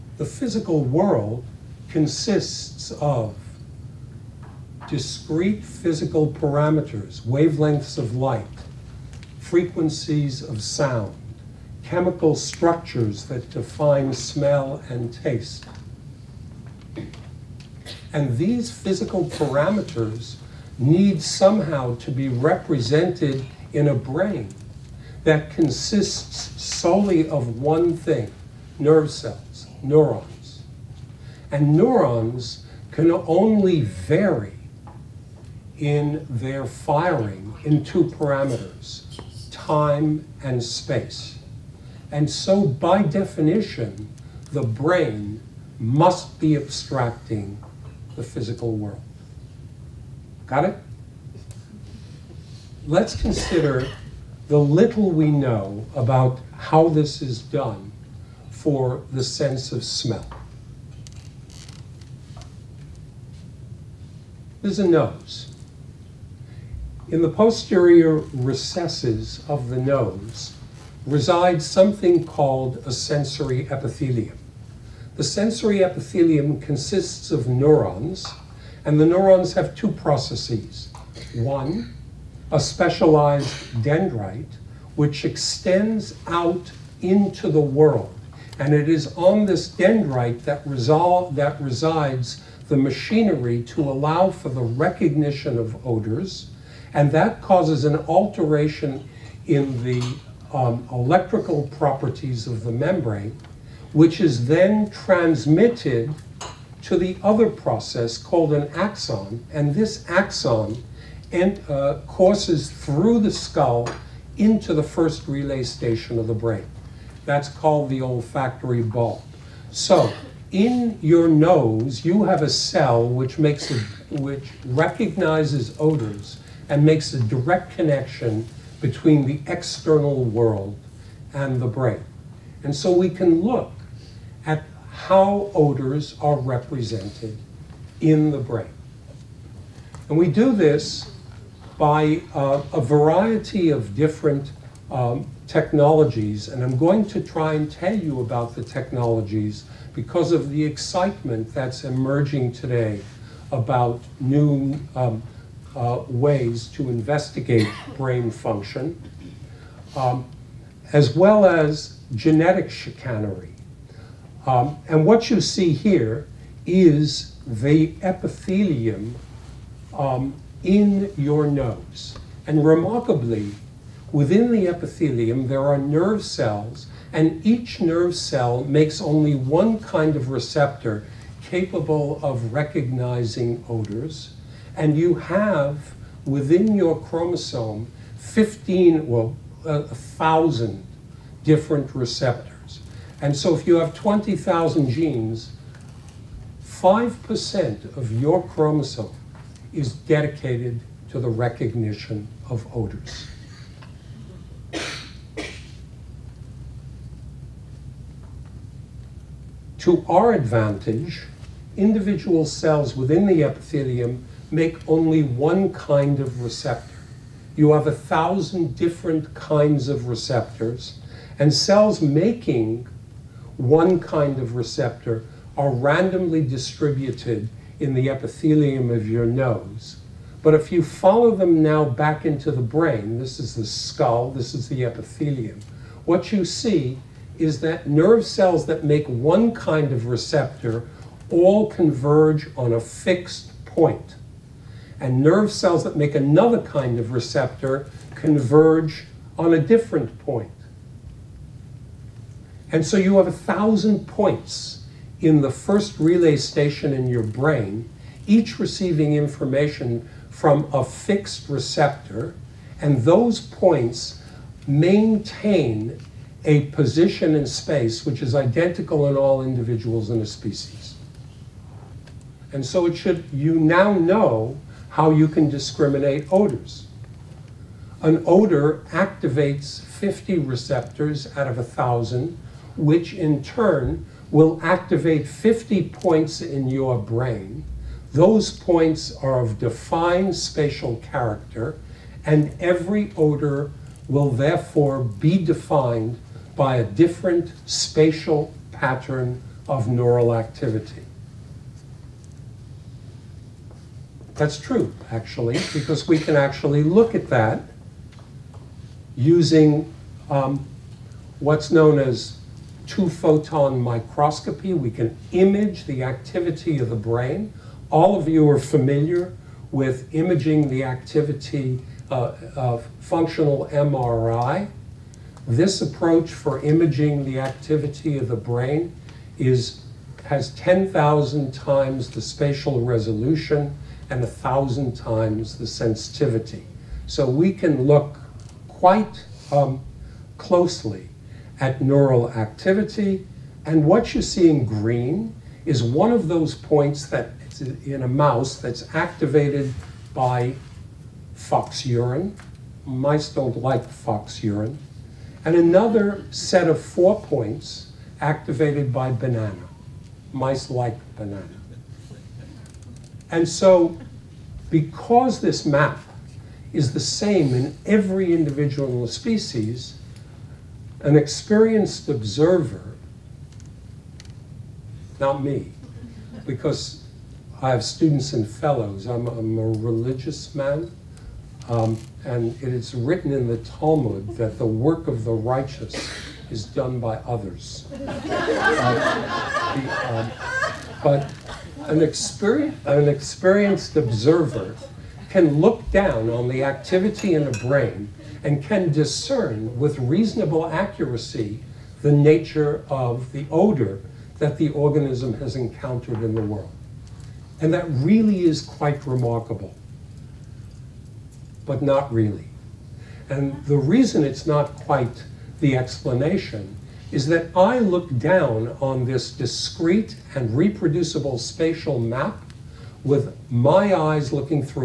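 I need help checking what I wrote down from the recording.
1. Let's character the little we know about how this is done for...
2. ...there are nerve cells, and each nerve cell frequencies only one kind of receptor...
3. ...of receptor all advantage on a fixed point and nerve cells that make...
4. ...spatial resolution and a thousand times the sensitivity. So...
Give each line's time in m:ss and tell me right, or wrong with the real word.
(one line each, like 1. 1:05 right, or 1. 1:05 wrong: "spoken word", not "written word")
1. 0:52 wrong: "consider", not "character"
2. 2:55 wrong: "makes", not "frequencies"
3. 3:59 wrong: "converge", not "advantage"
4. 5:32 right.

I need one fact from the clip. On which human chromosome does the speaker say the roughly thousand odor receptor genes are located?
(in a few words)
15.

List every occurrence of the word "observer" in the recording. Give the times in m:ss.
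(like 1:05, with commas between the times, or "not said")
6:12, 6:33.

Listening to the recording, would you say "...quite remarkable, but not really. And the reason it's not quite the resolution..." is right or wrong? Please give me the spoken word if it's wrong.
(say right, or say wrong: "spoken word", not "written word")
wrong: "explanation", not "resolution".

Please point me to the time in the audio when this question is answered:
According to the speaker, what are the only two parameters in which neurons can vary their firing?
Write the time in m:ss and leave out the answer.
0:39.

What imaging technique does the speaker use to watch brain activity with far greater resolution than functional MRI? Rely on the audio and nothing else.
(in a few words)
two-photon microscopy.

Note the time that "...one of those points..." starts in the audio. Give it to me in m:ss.
5:45.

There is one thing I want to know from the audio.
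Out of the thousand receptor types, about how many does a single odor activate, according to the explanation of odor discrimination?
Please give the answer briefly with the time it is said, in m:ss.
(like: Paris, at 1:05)
50, at 4:39.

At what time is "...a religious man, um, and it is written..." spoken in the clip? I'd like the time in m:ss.
6:19.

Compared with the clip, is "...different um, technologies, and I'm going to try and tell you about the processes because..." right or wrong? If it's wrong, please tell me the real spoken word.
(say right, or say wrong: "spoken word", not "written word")
wrong: "technologies", not "processes".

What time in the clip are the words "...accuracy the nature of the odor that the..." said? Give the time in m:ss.
6:40.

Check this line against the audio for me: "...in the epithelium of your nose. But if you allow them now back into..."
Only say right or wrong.
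wrong.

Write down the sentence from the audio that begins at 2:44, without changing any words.
Um, and what you see here is the epithelium um, in your nose.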